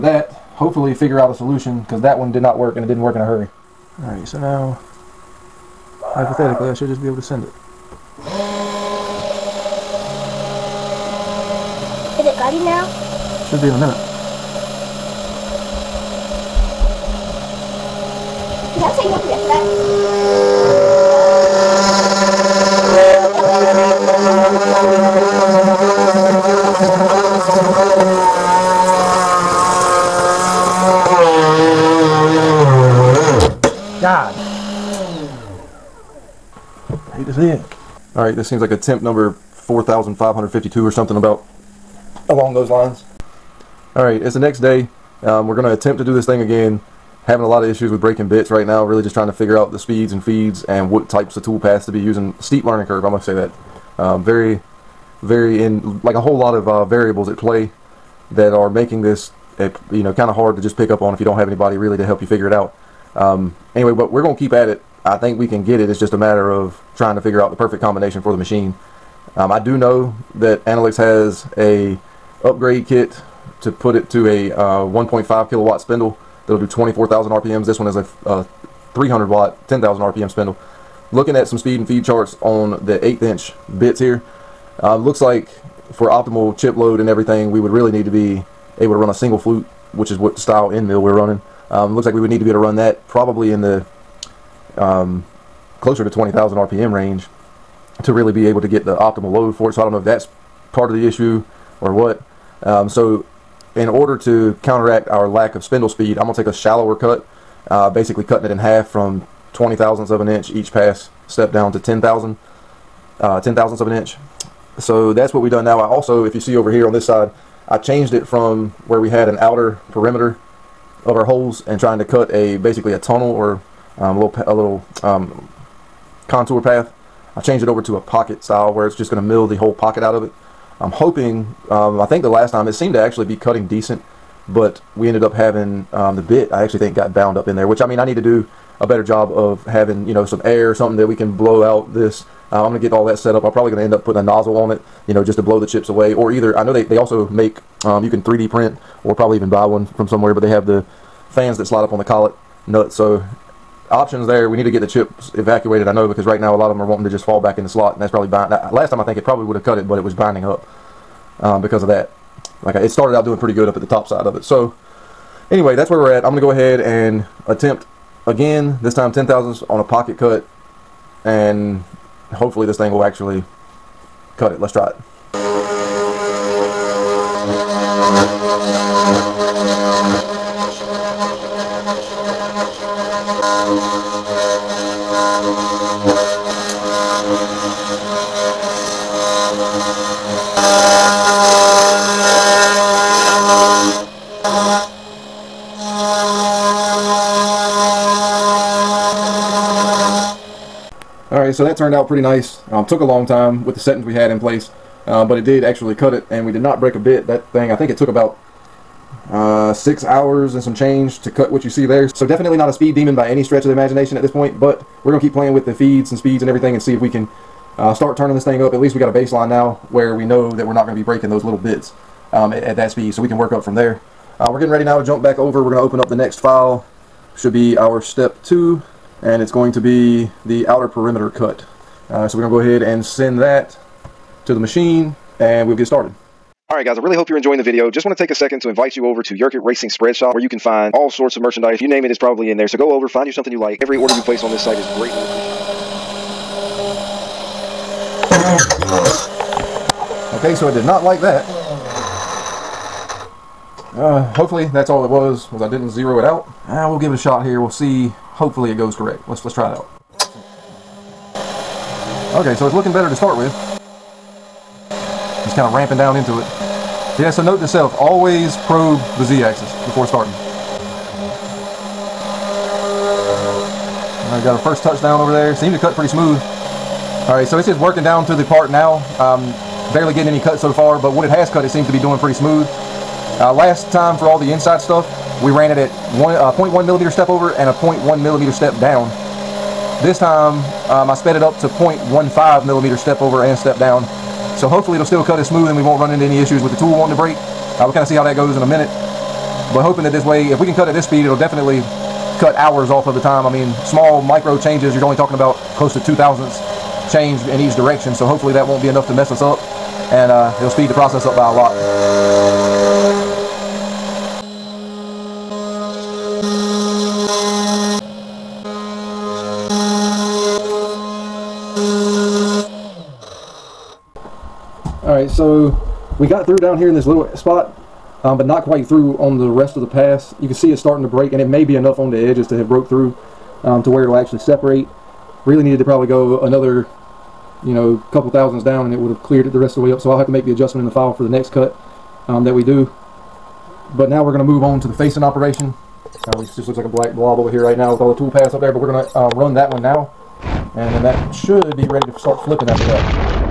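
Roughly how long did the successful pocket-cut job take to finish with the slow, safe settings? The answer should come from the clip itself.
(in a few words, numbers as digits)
about 6 hours.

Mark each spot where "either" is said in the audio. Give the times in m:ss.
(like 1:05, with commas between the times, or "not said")
2:26.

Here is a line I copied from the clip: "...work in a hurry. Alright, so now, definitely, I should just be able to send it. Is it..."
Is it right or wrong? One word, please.
wrong.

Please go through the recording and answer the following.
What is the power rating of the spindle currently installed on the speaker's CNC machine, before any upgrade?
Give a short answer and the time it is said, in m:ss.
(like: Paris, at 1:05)
300 watt, at 1:18.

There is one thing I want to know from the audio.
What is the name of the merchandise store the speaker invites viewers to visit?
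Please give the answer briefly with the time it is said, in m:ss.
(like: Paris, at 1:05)
Yerkit Racing Spread Shop, at 3:59.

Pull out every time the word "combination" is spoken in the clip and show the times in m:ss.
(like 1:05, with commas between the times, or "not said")
1:07.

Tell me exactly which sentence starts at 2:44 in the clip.
So anyway, that's where we're at.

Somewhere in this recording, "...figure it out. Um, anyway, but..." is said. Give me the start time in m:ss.
1:02.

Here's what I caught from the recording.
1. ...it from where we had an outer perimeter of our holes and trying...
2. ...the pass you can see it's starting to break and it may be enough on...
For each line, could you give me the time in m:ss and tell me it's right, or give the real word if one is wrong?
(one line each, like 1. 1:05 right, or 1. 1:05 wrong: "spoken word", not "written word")
1. 1:58 right
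2. 5:29 right.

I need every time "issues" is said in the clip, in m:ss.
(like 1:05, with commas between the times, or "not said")
0:47, 1:41, 4:56.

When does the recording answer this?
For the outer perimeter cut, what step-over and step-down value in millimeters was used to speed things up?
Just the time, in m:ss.
4:51.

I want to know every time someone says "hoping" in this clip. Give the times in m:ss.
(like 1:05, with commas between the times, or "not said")
2:10, 4:59.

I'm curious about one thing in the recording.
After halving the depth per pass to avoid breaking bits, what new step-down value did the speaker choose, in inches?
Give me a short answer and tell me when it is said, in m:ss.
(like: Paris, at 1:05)
10 thousandths, at 1:53.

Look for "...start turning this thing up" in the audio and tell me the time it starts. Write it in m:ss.
3:37.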